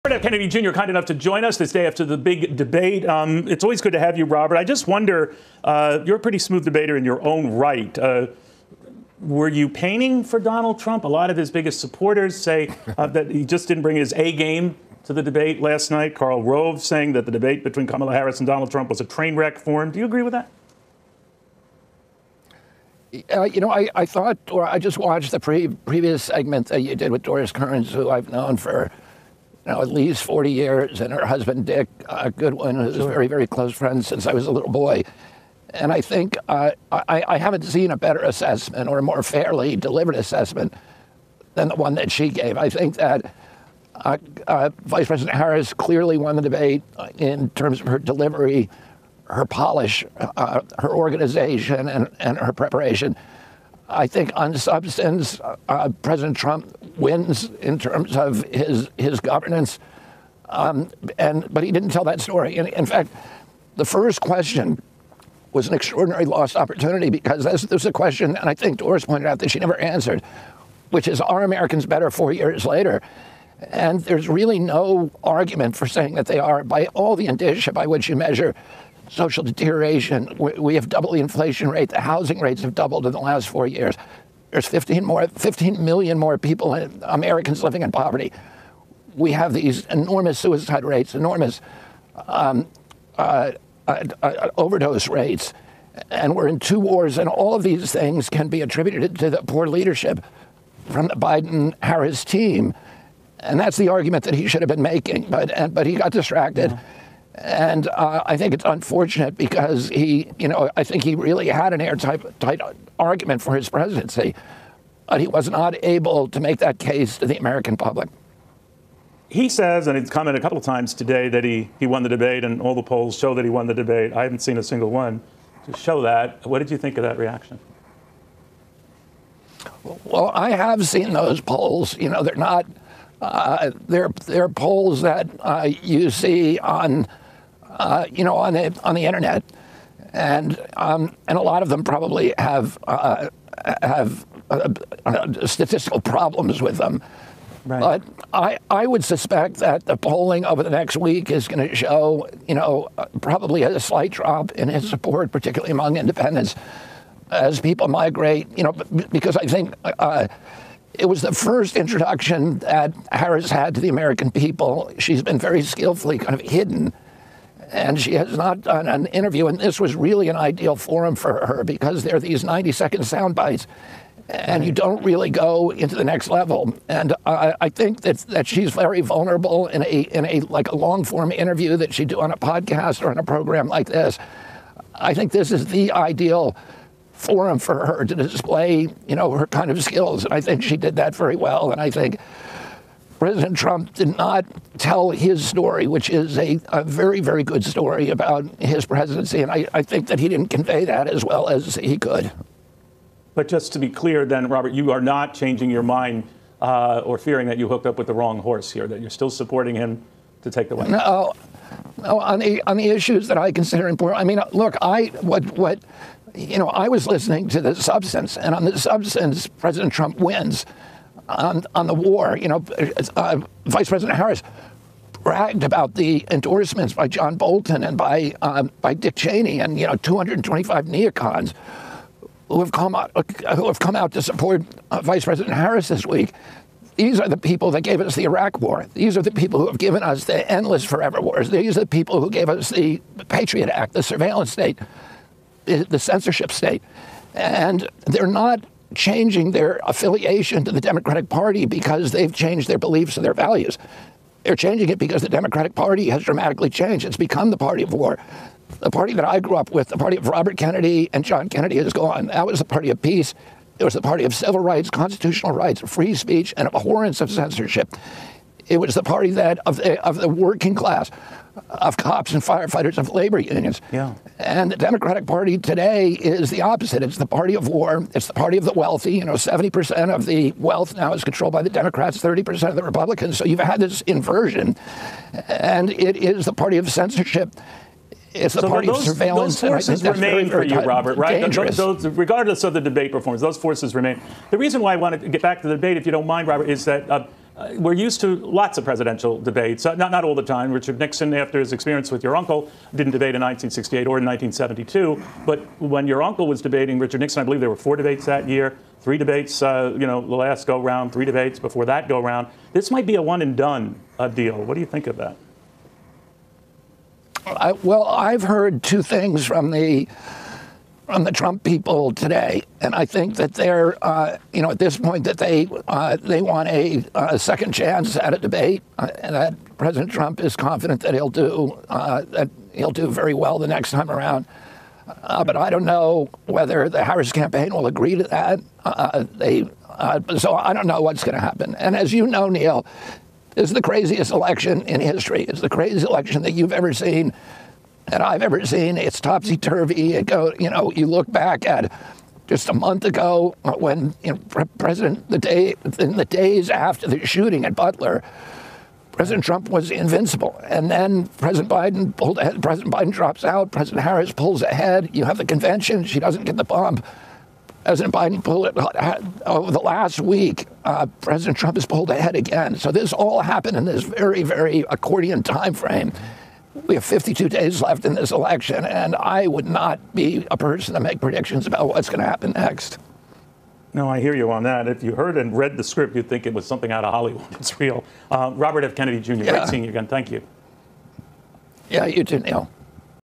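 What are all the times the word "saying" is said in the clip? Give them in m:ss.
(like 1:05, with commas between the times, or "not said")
0:16, 1:15.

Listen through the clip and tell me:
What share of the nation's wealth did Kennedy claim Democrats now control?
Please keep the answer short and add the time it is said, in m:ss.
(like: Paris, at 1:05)
70%, at 4:39.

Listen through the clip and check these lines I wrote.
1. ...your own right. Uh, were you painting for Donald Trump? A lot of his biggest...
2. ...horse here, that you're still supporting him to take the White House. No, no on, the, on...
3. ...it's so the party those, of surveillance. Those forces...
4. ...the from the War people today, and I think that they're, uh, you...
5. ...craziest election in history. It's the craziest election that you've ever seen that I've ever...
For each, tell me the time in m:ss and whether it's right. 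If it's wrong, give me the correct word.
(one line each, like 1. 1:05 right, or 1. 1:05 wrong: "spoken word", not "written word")
1. 0:07 right
2. 3:28 right
3. 4:48 right
4. 5:19 wrong: "Trump", not "War"
5. 5:43 right.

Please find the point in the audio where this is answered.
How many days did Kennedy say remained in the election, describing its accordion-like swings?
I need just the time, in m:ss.
6:17.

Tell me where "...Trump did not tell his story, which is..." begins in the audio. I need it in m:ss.
3:13.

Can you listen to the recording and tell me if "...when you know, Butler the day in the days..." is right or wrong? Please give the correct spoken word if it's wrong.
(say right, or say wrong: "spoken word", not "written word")
wrong: "President", not "Butler".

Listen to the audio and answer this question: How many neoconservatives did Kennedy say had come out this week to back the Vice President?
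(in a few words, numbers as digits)
225.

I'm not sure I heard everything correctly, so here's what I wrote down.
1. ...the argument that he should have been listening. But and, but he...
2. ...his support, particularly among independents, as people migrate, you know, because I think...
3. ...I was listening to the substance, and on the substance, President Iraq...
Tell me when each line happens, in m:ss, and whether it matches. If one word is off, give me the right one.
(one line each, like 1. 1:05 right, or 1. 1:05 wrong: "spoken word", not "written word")
1. 1:43 wrong: "making", not "listening"
2. 2:34 right
3. 3:36 wrong: "Trump", not "Iraq".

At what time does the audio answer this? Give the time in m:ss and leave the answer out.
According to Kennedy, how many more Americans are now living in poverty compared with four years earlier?
1:25.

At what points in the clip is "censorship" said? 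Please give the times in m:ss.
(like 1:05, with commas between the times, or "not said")
4:05, 4:27, 4:46.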